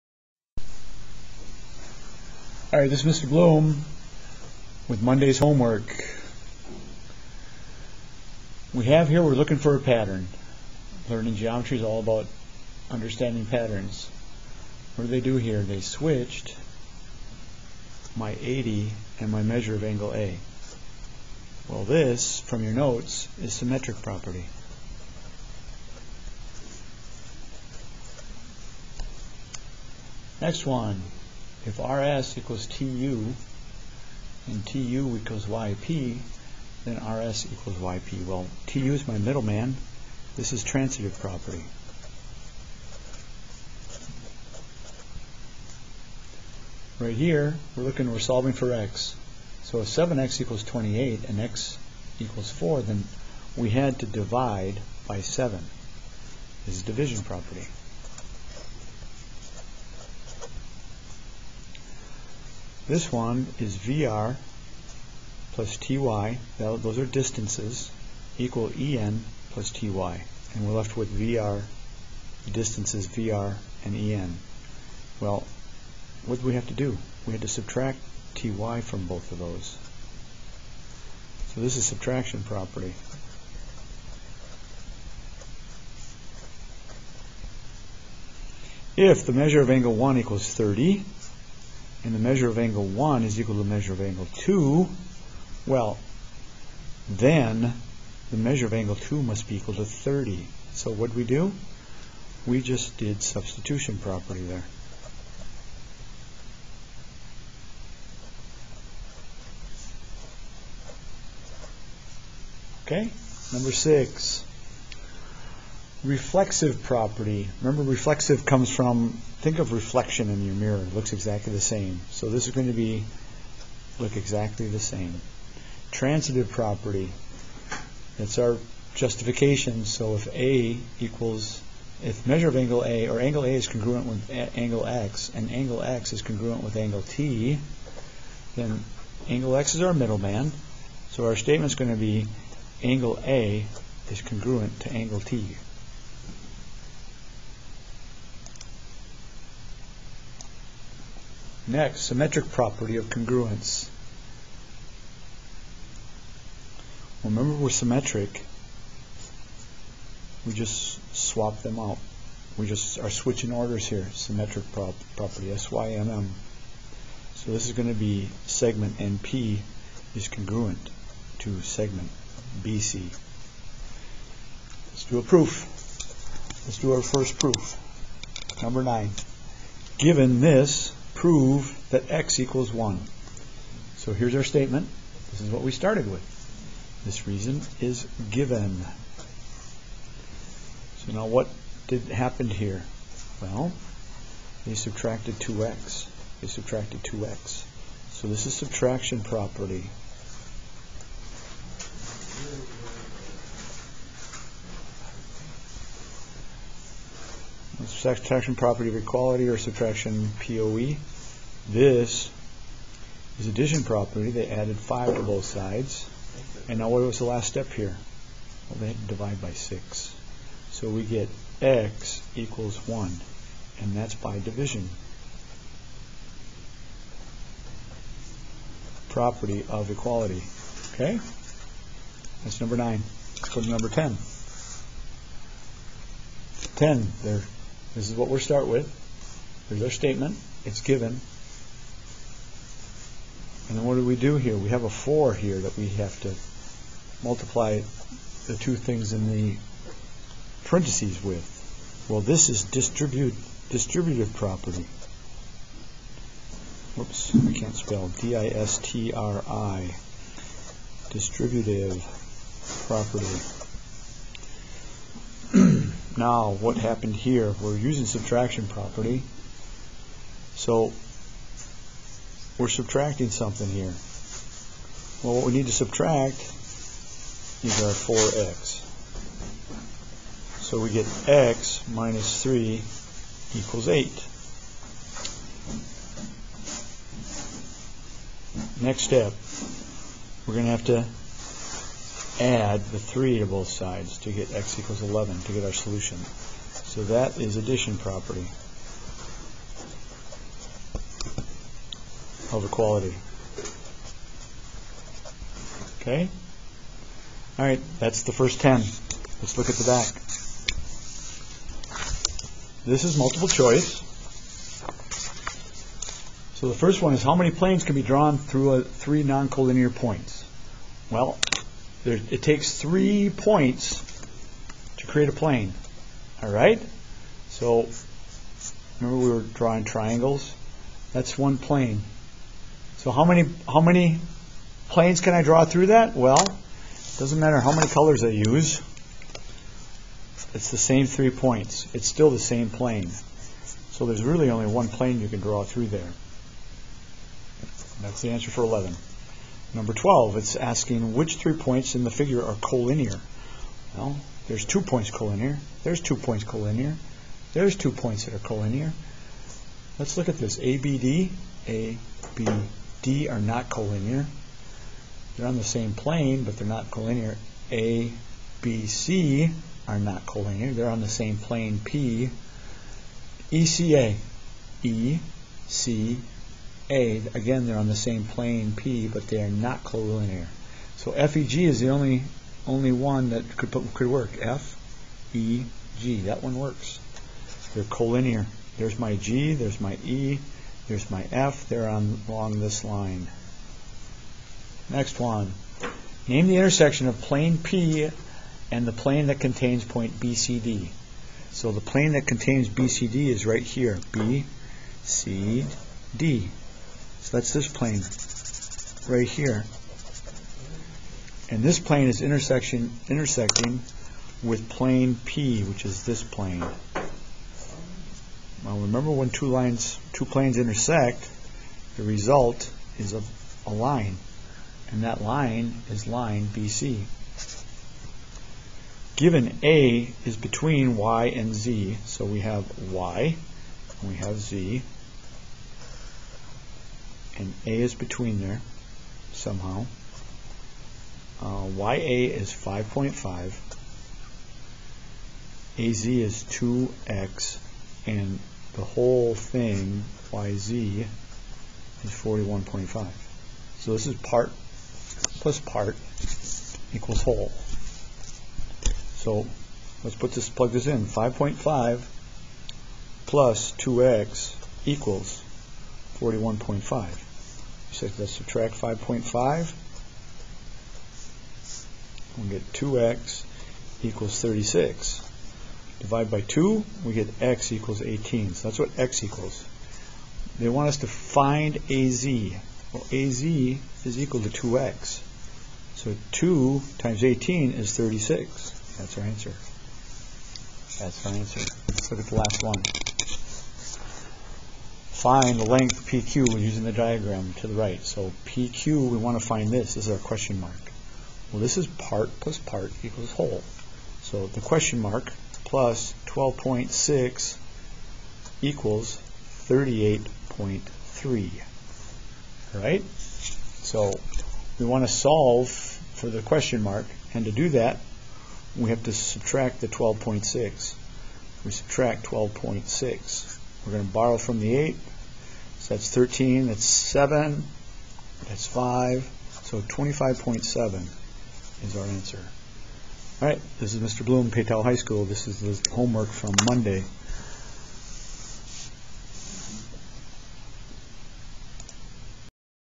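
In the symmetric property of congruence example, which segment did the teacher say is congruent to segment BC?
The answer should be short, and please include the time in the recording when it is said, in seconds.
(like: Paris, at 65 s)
Segment NP, at 168 s.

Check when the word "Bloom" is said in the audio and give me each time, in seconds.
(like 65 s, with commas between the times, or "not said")
3 s, 534 s.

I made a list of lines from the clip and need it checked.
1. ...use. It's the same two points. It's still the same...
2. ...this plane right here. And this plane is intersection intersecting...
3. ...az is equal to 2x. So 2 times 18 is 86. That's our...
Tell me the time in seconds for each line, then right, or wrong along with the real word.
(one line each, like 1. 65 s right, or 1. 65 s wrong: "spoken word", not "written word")
1. 338 s wrong: "three", not "two"
2. 407 s right
3. 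483 s wrong: "36", not "86".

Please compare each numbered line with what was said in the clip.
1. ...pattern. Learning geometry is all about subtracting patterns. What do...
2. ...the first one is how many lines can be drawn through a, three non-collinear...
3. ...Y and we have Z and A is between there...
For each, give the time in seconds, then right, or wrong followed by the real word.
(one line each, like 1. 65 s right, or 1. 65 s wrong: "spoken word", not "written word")
1. 9 s wrong: "understanding", not "subtracting"
2. 316 s wrong: "planes", not "lines"
3. 432 s right.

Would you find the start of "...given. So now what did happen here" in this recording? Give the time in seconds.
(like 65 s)
188 s.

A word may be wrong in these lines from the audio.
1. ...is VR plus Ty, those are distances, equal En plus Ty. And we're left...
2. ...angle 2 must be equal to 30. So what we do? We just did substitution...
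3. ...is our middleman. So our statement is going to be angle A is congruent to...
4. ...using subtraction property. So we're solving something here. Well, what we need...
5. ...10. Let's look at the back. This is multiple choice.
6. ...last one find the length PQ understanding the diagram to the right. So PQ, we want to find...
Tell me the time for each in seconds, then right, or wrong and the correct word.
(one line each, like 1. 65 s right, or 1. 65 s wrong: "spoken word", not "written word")
1. 63 s right
2. 98 s right
3. 139 s right
4. 267 s wrong: "subtracting", not "solving"
5. 308 s right
6. 492 s wrong: "using", not "understanding".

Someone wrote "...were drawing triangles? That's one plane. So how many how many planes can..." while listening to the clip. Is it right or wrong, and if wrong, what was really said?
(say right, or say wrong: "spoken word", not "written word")
right.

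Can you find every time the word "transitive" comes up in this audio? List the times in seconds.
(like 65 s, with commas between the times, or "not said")
40 s, 125 s.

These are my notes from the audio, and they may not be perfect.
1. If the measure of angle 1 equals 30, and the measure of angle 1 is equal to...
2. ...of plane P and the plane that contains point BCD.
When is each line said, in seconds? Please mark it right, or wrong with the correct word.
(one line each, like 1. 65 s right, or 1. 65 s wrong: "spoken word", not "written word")
1. 88 s right
2. 397 s right.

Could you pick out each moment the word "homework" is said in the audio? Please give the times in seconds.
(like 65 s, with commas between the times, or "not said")
5 s, 535 s.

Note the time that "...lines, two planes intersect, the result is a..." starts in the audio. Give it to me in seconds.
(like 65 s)
419 s.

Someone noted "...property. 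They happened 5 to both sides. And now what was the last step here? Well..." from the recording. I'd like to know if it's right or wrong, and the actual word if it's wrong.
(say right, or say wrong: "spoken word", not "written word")
wrong: "added", not "happened".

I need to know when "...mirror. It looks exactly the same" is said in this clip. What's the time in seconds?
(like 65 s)
120 s.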